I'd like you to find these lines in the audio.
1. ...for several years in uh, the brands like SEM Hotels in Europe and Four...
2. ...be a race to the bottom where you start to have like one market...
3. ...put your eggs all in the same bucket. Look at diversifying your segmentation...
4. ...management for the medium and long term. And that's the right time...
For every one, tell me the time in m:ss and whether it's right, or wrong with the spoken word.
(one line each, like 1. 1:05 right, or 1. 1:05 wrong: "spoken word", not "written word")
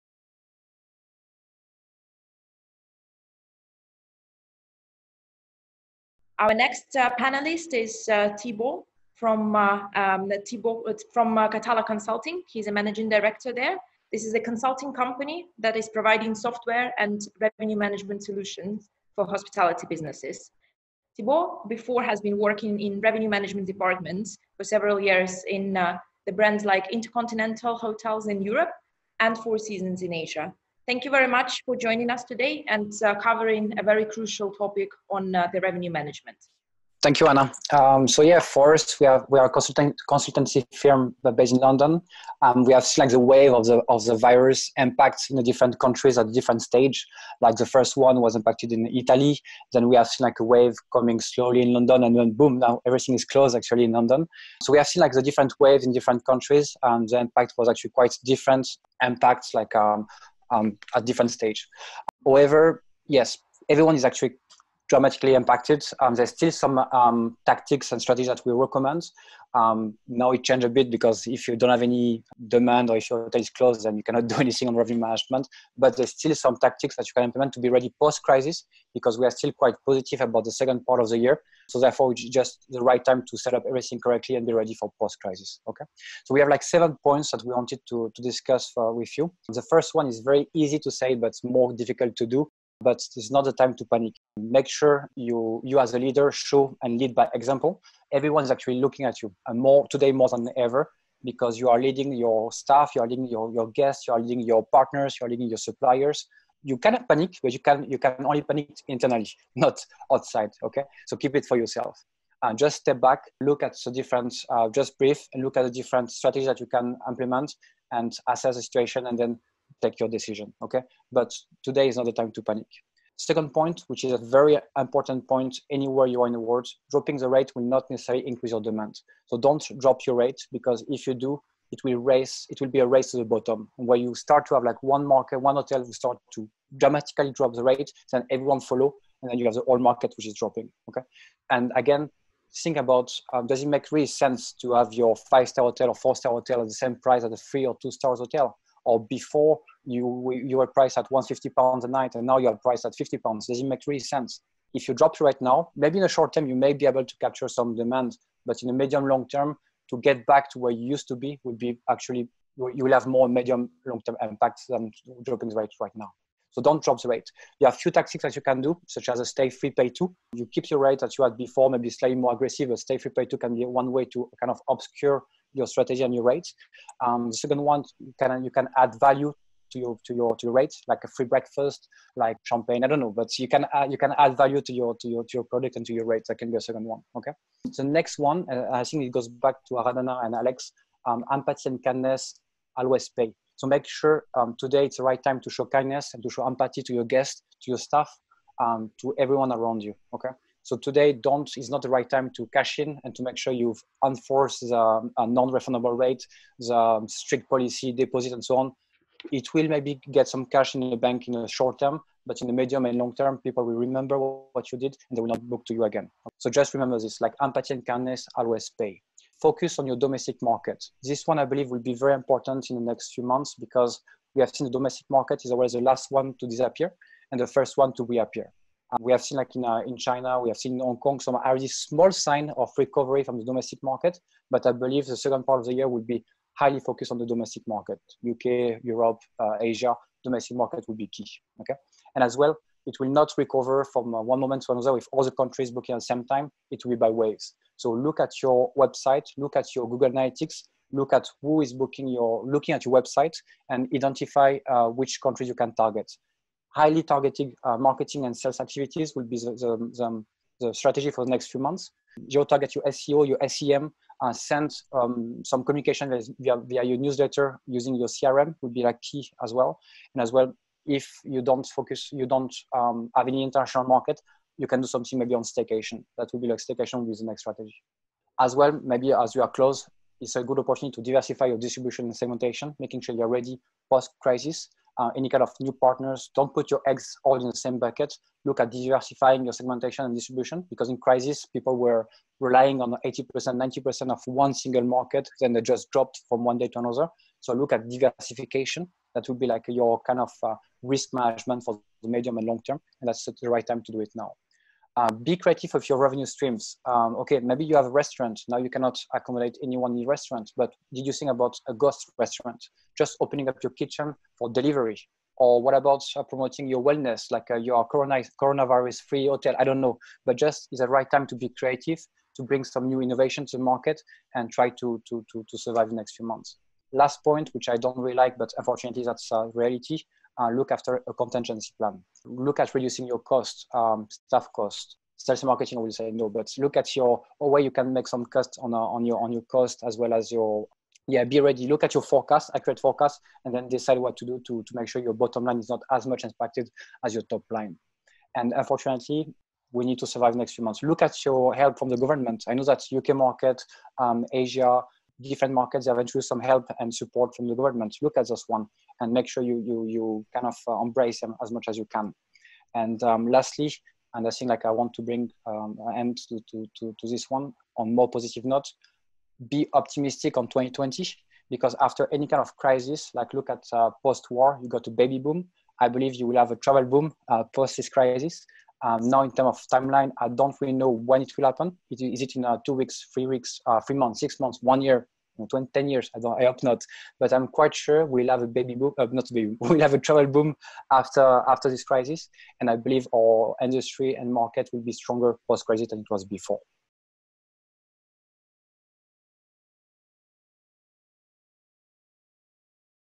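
1. 0:24 wrong: "Intercontinental", not "SEM"
2. 2:12 right
3. 4:46 right
4. 5:01 right.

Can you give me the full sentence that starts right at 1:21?
So therefore, it's just the right time to set up everything correctly and be ready for post crisis.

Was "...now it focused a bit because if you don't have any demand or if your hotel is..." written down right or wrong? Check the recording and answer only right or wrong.
wrong.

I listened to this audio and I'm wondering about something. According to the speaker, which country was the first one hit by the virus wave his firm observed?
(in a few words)
Italy.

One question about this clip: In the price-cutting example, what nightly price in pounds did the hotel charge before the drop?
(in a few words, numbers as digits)
150 pounds.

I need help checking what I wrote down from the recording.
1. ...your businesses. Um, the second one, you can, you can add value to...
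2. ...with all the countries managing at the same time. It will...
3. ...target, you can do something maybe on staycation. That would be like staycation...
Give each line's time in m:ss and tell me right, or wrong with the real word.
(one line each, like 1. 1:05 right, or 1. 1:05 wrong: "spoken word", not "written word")
1. 2:56 wrong: "rates", not "businesses"
2. 4:04 wrong: "booking", not "managing"
3. 4:33 wrong: "market", not "target".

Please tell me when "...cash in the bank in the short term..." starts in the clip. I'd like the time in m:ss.
3:30.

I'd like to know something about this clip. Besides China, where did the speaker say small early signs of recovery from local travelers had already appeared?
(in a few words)
Hong Kong.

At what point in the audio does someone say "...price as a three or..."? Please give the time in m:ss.
2:26.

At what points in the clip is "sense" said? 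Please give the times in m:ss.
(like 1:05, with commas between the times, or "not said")
2:24, 2:33.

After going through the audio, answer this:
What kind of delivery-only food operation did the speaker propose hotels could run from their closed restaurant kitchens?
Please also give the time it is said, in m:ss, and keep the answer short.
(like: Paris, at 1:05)
ghost restaurant, at 5:11.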